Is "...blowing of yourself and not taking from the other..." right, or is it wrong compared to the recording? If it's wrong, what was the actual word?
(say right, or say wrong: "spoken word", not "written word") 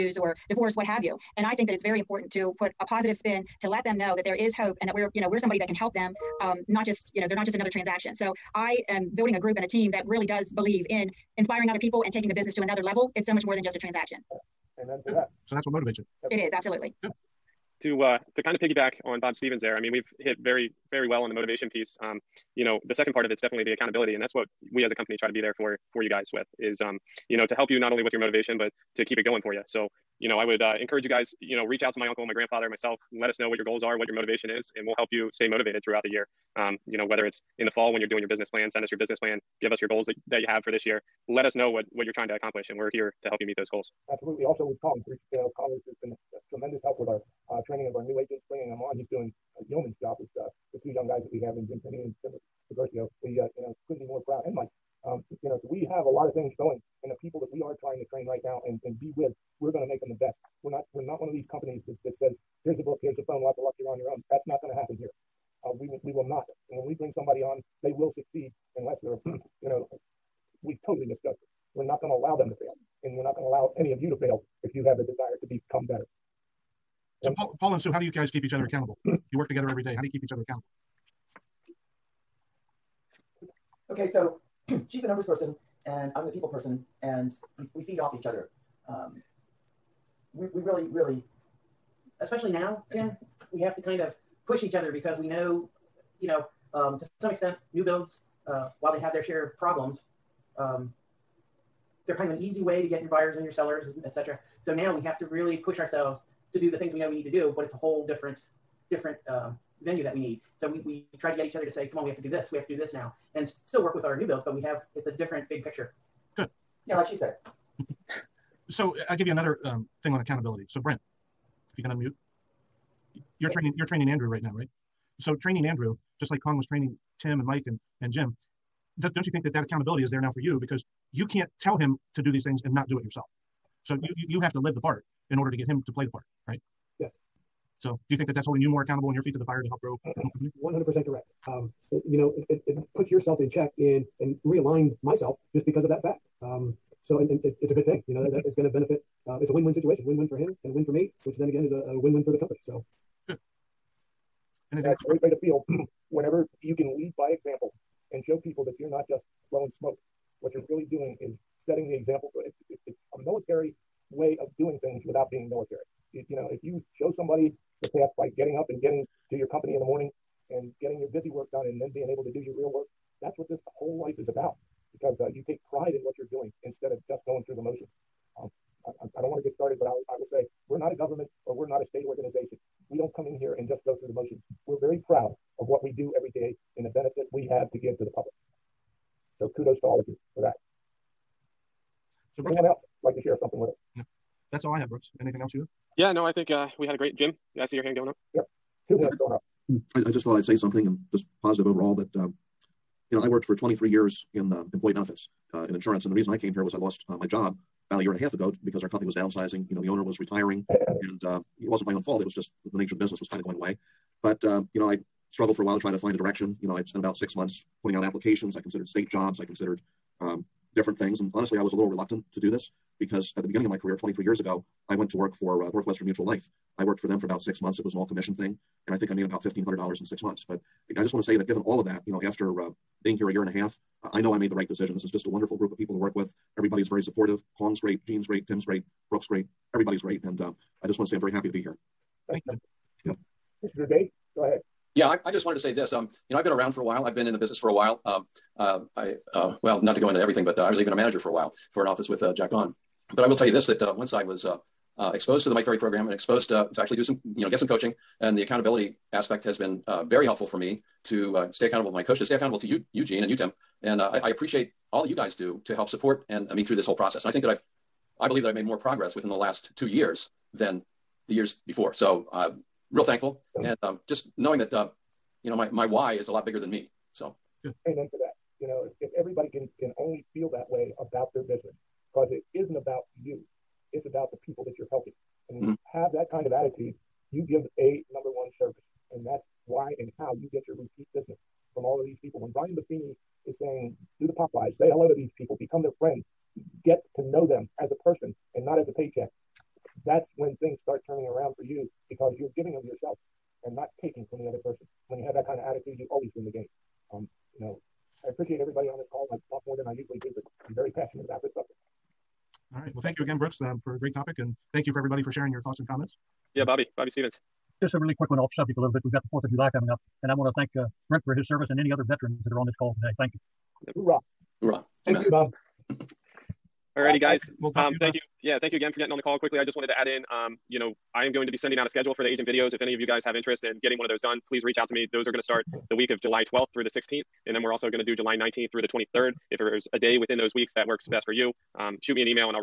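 wrong: "giving", not "blowing".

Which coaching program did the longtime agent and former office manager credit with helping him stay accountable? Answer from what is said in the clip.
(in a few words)
Mike Ferry program.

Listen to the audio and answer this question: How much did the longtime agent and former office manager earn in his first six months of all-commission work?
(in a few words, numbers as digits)
$1,500.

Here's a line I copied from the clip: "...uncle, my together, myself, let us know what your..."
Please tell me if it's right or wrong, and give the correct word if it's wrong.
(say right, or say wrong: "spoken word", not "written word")
wrong: "grandfather", not "together".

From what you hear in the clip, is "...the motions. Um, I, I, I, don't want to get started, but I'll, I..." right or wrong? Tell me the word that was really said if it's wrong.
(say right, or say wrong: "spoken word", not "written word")
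right.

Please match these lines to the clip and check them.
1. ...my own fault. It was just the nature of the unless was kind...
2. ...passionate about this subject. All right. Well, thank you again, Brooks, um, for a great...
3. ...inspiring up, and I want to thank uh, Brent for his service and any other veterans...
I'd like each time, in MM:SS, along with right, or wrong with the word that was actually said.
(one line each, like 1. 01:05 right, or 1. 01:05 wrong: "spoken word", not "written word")
1. 03:31 wrong: "business", not "unless"
2. 05:10 right
3. 05:19 wrong: "coming", not "inspiring".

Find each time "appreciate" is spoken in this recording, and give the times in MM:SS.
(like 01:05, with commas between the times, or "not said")
04:24, 05:08.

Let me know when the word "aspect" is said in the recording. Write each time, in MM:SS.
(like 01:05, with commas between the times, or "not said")
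04:19.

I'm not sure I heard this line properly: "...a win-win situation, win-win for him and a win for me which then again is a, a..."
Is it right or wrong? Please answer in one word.
right.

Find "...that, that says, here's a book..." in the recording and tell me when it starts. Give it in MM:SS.
01:01.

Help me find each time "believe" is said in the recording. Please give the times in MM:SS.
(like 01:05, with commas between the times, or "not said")
00:10, 04:28.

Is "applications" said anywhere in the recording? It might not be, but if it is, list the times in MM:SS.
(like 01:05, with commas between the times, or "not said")
03:38.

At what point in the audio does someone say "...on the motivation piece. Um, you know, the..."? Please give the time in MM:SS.
00:21.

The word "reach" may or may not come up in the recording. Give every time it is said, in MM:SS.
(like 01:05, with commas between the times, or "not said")
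00:31, 05:34.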